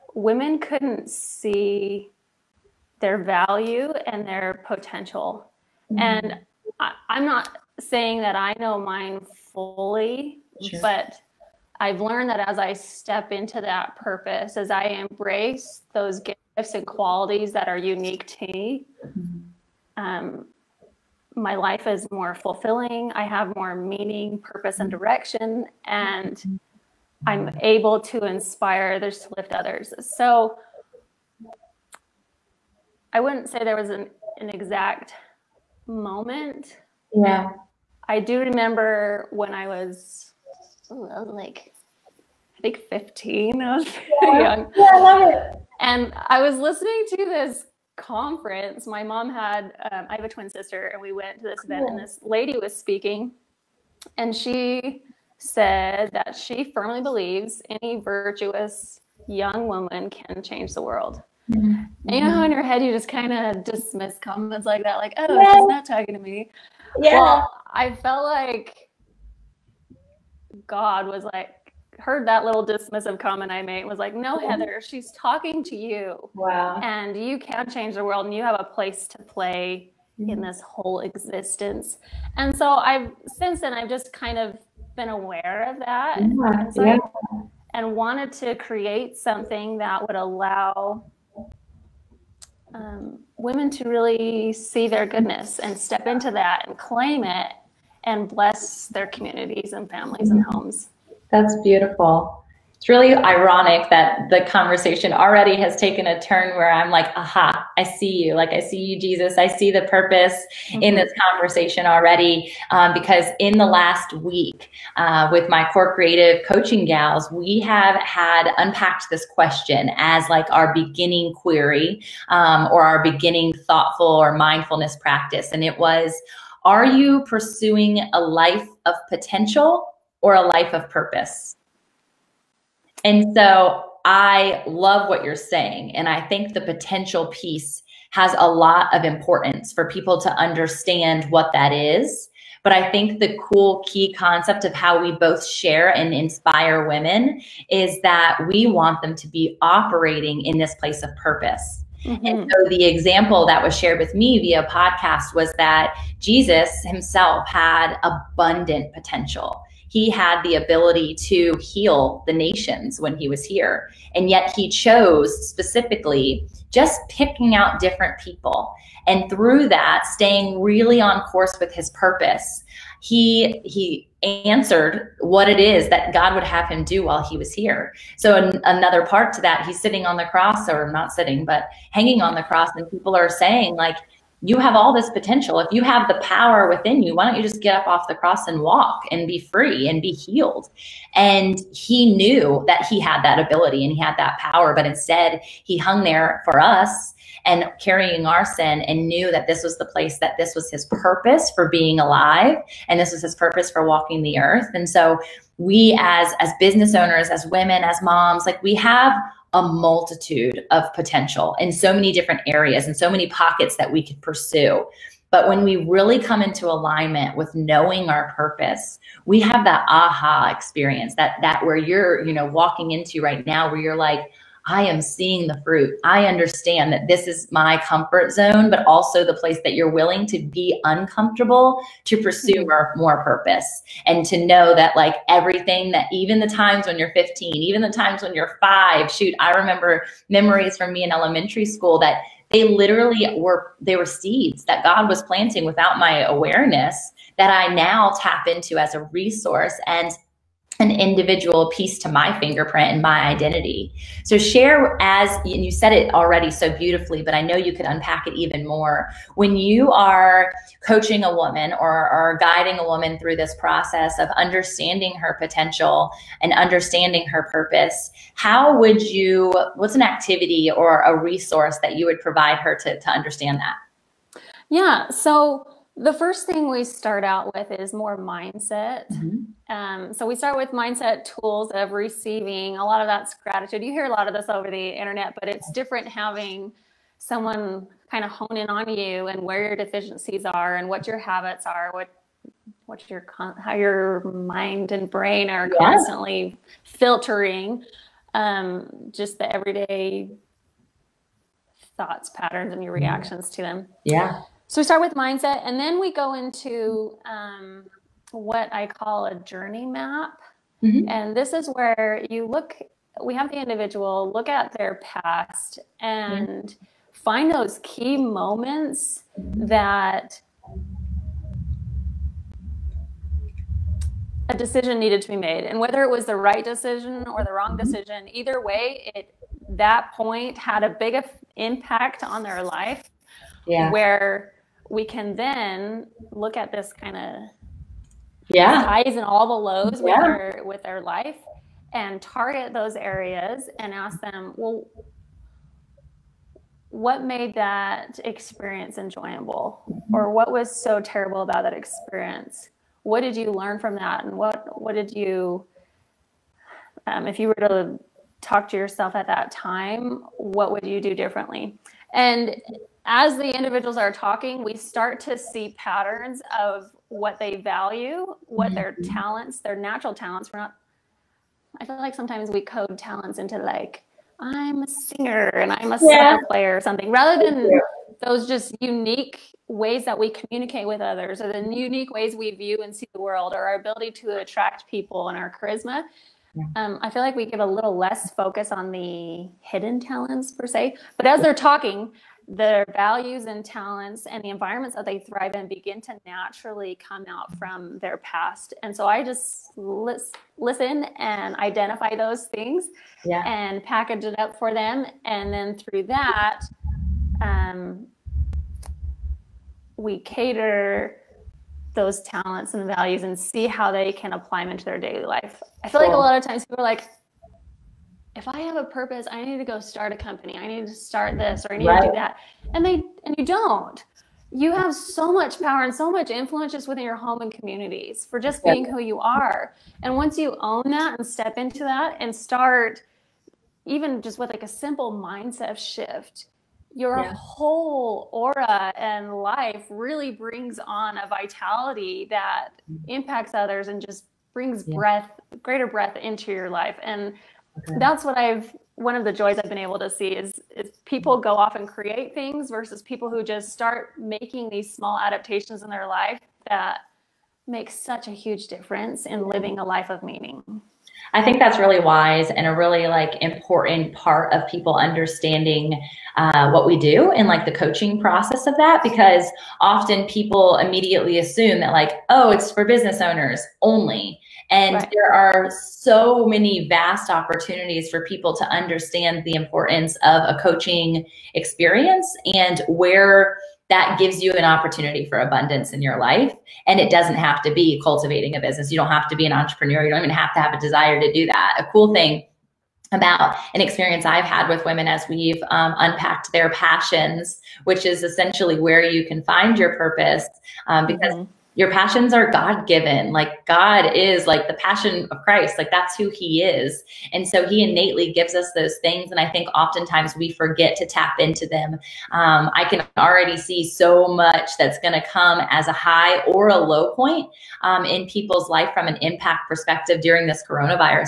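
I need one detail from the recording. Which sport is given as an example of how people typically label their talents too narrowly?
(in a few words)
soccer.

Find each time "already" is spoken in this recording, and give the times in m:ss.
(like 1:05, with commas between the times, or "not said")
1:45, 1:51, 4:16, 8:33.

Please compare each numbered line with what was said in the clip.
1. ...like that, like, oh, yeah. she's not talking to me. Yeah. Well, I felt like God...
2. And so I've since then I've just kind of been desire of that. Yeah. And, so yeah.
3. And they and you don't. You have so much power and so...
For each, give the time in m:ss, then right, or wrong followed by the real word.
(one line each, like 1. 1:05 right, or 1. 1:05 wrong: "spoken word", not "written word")
1. 1:04 right
2. 1:22 wrong: "aware", not "desire"
3. 7:02 right.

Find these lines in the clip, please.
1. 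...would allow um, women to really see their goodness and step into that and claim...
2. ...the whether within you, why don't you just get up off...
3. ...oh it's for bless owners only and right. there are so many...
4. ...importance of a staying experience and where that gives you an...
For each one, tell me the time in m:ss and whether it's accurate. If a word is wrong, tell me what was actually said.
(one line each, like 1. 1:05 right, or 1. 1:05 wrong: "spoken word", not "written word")
1. 1:30 right
2. 3:06 wrong: "power", not "whether"
3. 7:52 wrong: "business", not "bless"
4. 7:59 wrong: "coaching", not "staying".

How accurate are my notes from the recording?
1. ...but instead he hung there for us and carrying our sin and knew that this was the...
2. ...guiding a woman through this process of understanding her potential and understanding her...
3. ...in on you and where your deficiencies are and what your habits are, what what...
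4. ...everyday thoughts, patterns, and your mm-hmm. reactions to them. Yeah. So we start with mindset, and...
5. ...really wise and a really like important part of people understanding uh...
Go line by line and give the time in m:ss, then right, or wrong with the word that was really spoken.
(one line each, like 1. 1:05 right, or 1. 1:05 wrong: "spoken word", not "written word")
1. 3:14 right
2. 4:22 right
3. 4:48 right
4. 4:59 right
5. 7:41 right.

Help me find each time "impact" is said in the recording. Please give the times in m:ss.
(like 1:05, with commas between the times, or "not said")
5:31, 7:23, 8:39.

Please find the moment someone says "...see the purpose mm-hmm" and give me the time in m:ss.
1:49.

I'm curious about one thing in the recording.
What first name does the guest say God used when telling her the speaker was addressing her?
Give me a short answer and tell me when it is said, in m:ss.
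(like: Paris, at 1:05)
Heather, at 1:14.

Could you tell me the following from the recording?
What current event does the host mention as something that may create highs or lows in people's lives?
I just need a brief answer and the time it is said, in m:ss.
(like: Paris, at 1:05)
coronavirus, at 8:40.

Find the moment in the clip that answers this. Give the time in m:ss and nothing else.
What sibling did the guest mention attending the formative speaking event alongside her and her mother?
0:50.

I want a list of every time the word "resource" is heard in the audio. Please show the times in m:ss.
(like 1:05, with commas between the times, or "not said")
4:09, 4:31.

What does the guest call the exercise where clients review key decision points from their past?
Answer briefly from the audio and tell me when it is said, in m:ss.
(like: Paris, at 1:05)
journey map, at 5:09.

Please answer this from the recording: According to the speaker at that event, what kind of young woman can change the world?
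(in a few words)
virtuous.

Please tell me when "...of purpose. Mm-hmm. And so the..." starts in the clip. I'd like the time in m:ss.
2:31.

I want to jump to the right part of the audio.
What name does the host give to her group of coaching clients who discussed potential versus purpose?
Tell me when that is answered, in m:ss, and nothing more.
1:55.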